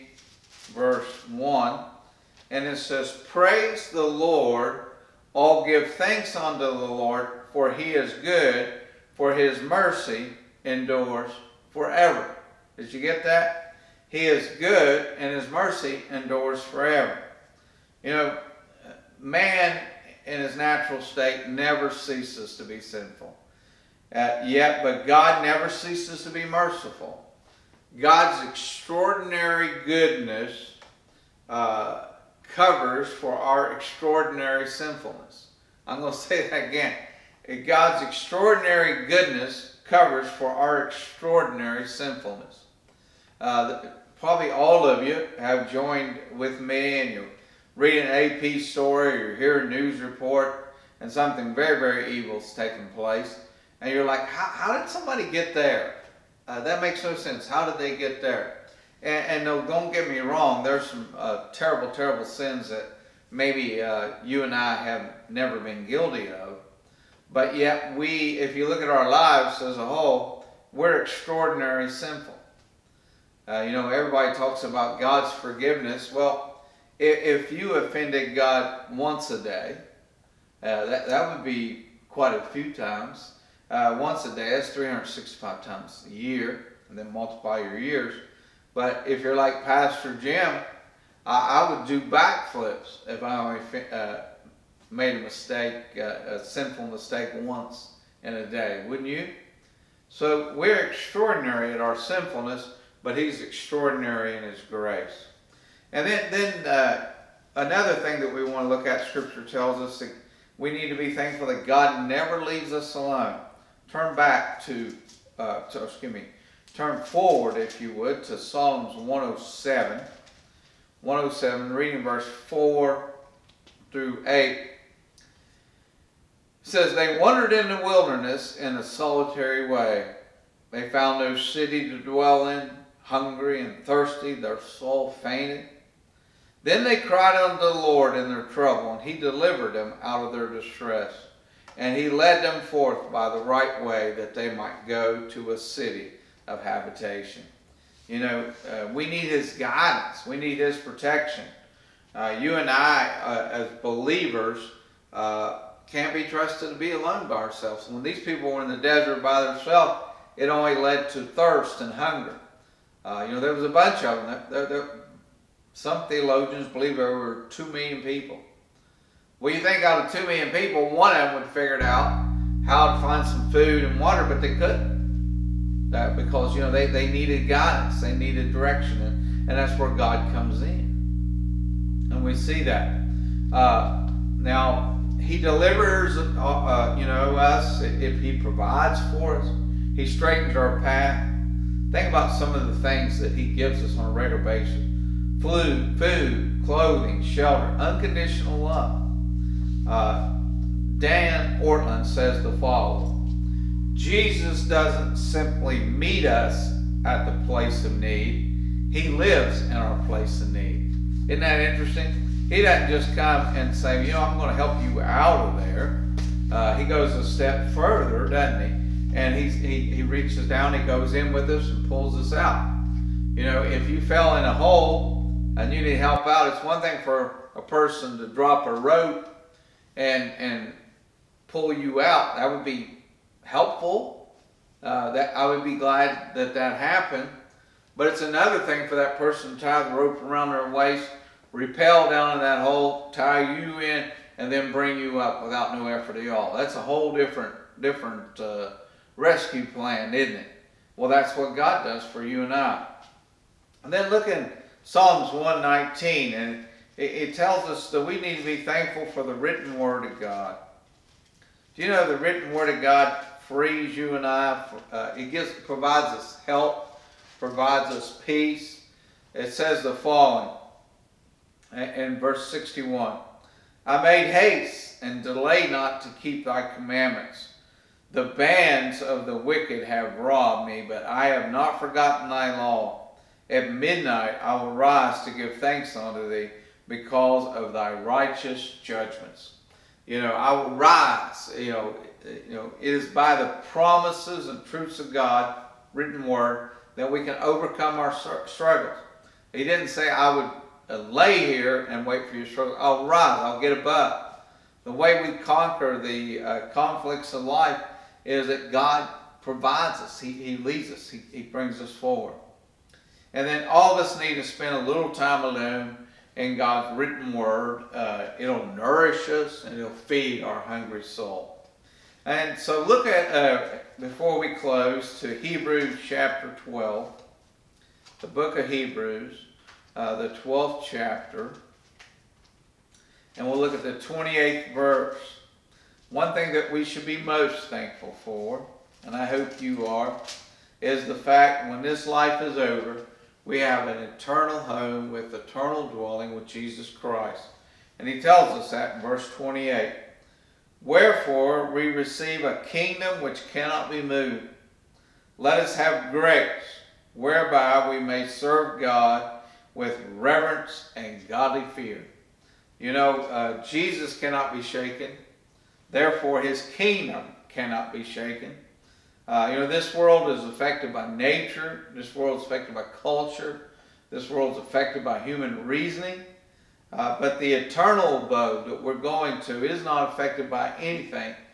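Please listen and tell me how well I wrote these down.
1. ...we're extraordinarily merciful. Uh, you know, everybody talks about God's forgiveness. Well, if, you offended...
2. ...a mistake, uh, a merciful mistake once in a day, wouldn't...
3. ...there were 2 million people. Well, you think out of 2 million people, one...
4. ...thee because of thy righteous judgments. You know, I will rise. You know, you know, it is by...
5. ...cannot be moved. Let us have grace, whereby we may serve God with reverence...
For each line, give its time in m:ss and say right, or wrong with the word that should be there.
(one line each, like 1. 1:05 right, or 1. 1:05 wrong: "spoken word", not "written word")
1. 1:10 wrong: "sinful", not "merciful"
2. 1:35 wrong: "sinful", not "merciful"
3. 2:46 right
4. 4:46 right
5. 5:53 right.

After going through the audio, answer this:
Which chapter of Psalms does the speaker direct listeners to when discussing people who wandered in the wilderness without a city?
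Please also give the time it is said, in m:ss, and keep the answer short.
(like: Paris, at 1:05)
Psalms 107, at 1:58.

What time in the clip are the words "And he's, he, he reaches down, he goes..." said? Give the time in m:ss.
3:39.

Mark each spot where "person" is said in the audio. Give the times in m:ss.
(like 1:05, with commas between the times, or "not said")
3:47, 3:59.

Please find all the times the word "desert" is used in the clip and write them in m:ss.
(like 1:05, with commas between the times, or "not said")
2:38.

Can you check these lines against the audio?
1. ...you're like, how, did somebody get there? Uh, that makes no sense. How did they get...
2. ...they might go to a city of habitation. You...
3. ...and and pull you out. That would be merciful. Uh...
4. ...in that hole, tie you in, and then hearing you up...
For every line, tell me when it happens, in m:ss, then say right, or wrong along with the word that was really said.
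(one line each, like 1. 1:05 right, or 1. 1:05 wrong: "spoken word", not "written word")
1. 0:53 right
2. 2:24 right
3. 3:49 wrong: "helpful", not "merciful"
4. 4:02 wrong: "bring", not "hearing".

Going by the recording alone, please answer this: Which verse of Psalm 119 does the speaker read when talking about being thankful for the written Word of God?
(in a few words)
61.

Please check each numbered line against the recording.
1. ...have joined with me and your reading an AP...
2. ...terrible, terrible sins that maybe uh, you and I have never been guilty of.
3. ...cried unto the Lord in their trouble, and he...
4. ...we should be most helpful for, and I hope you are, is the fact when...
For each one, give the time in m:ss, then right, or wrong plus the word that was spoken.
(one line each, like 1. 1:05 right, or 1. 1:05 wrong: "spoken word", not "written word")
1. 0:45 right
2. 1:01 right
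3. 2:16 right
4. 5:36 wrong: "thankful", not "helpful".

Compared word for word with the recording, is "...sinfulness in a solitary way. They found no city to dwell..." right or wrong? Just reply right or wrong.
wrong.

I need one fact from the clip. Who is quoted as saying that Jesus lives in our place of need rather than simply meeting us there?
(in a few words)
Dan Ortlund.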